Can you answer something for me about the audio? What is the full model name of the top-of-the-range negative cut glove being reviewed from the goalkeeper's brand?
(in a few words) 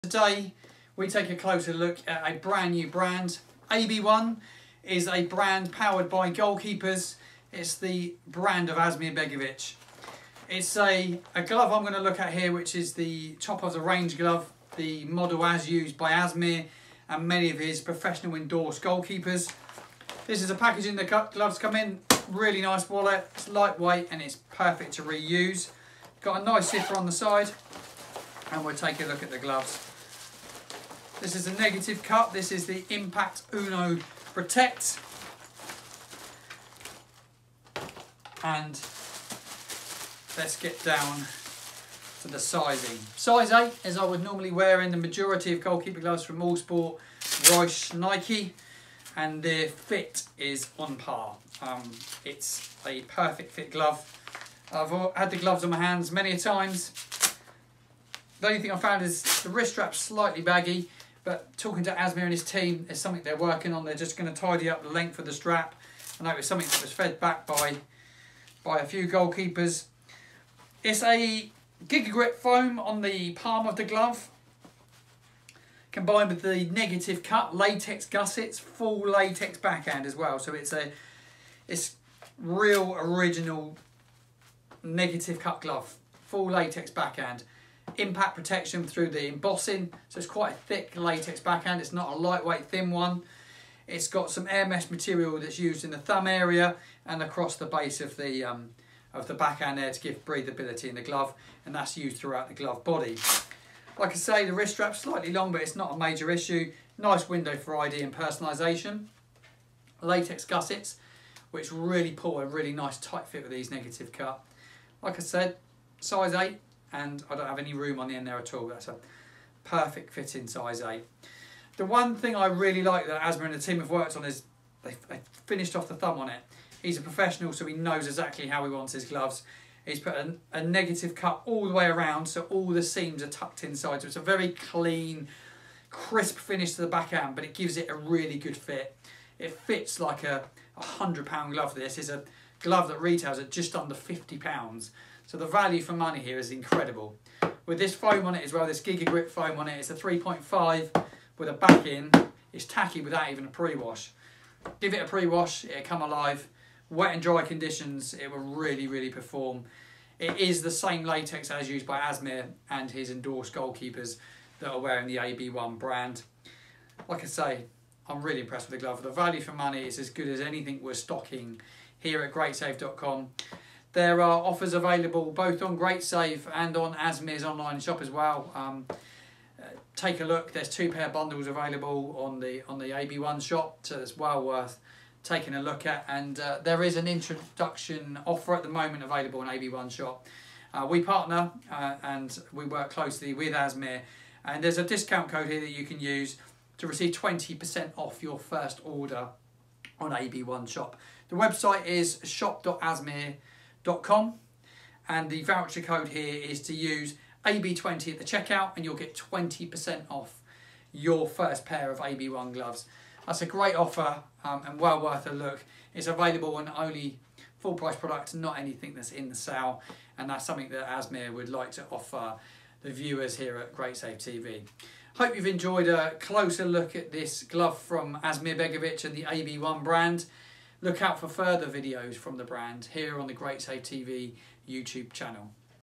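Impact Uno Protect.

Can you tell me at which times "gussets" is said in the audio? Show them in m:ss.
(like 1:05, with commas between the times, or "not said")
1:18, 1:50.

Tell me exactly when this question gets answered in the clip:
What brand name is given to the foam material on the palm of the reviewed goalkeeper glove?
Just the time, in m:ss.
1:11.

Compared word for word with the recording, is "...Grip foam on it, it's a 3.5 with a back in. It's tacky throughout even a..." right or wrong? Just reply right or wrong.
wrong.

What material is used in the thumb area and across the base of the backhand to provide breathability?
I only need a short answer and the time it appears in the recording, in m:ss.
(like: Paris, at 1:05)
Air mesh, at 1:34.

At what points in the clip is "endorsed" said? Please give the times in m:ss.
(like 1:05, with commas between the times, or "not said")
0:18, 2:43.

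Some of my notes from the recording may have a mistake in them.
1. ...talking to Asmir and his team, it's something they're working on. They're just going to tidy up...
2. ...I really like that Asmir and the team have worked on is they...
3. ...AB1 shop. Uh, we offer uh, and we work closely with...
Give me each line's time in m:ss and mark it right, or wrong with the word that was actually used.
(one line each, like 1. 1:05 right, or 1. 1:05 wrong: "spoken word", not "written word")
1. 1:01 right
2. 2:02 right
3. 3:09 wrong: "partner", not "offer".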